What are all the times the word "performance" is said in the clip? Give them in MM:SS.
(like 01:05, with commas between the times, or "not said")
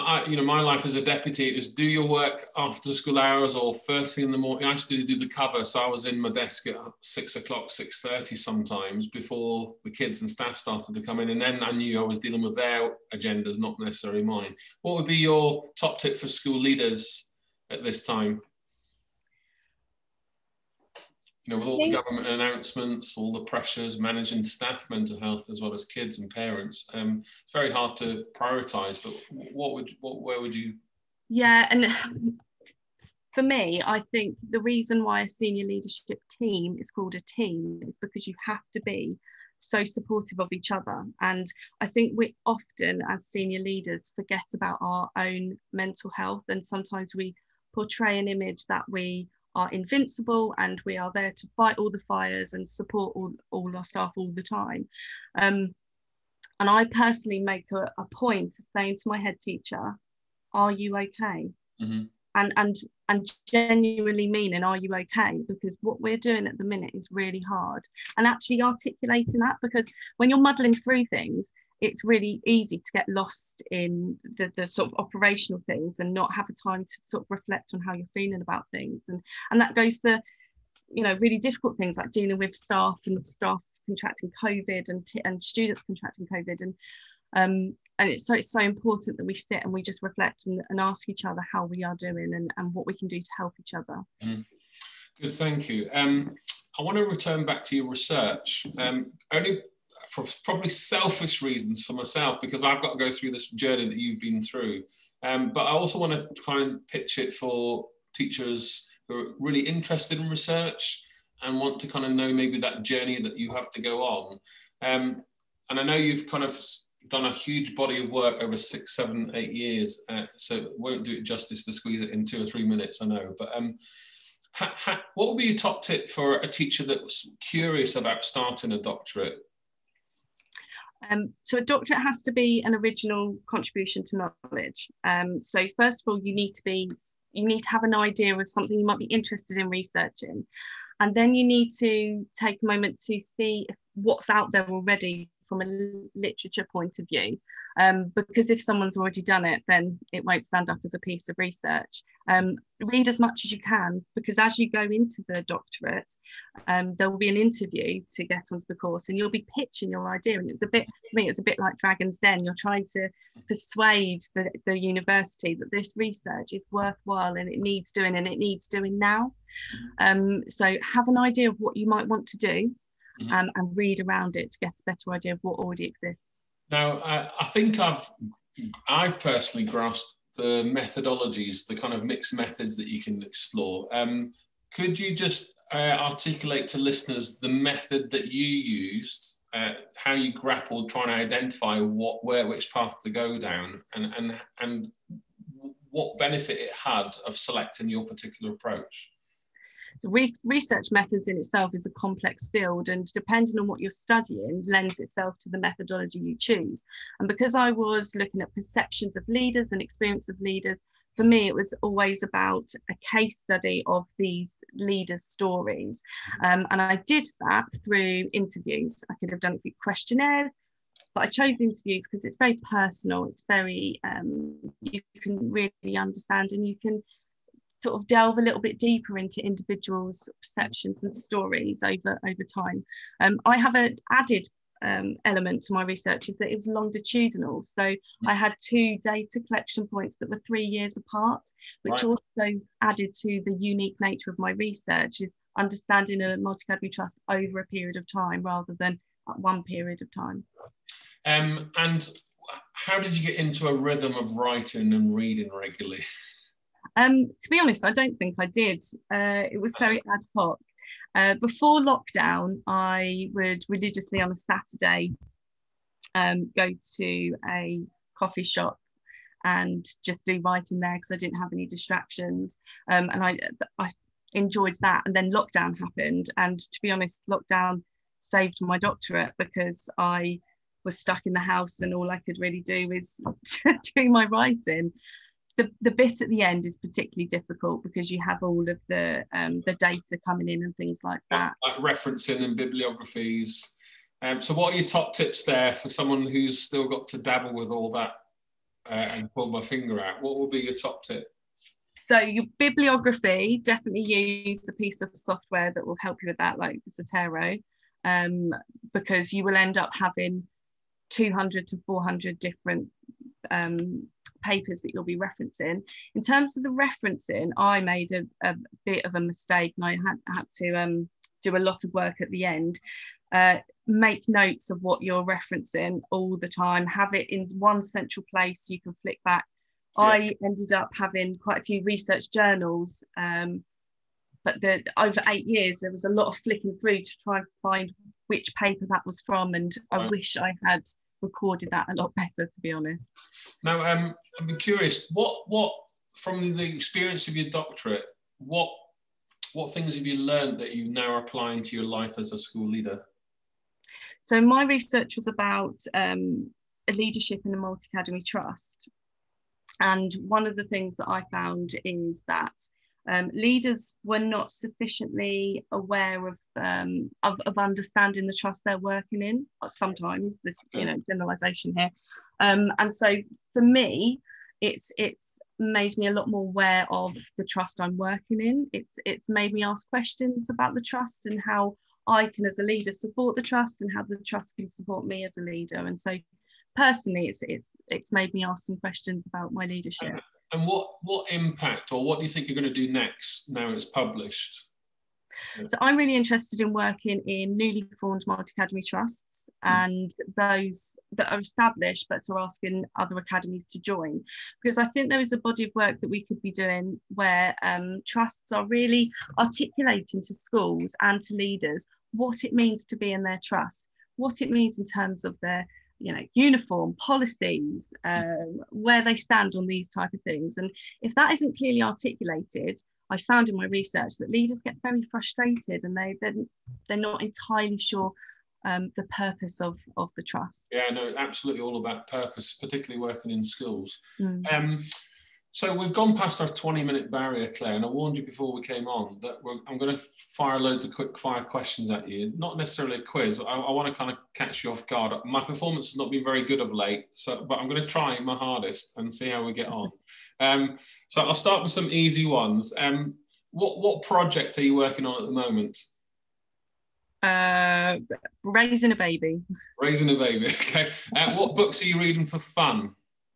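07:25.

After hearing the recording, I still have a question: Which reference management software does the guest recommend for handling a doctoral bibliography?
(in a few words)
Zotero.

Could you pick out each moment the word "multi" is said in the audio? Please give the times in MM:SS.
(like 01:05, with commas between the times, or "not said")
04:06, 05:57, 06:38.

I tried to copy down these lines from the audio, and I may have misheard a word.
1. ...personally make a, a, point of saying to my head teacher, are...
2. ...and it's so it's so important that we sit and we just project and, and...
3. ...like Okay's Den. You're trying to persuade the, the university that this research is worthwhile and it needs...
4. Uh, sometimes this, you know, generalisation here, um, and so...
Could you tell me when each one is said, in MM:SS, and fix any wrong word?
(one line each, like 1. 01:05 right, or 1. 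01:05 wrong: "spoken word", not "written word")
1. 00:56 right
2. 01:27 wrong: "reflect", not "project"
3. 02:41 wrong: "Dragon", not "Okay"
4. 06:09 right.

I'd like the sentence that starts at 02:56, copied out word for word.
Now, I, I think I've I've personally grasped the methodologies, the kind of mixed methods that you can explore.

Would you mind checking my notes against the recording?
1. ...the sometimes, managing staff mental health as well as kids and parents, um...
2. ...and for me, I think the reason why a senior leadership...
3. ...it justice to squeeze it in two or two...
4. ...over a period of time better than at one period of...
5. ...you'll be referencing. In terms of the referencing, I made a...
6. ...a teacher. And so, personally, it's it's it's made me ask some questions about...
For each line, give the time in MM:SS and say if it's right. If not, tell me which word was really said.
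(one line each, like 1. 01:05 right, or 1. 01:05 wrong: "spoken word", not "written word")
1. 00:23 wrong: "pressures", not "sometimes"
2. 00:31 right
3. 02:01 wrong: "three", not "two"
4. 04:07 wrong: "rather", not "better"
5. 05:14 right
6. 06:25 wrong: "leader", not "teacher".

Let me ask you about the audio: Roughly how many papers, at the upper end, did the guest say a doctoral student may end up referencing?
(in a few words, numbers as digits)
400.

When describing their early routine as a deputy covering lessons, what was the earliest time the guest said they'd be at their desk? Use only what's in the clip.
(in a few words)
6:00.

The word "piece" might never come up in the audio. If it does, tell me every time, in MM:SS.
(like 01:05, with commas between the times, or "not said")
02:30, 05:04.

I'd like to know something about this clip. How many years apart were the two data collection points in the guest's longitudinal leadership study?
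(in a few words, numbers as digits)
3 years.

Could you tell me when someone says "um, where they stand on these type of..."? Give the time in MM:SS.
06:58.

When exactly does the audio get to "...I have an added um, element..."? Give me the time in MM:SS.
03:53.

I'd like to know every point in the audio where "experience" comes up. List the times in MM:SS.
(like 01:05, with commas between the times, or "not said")
03:29, 05:46.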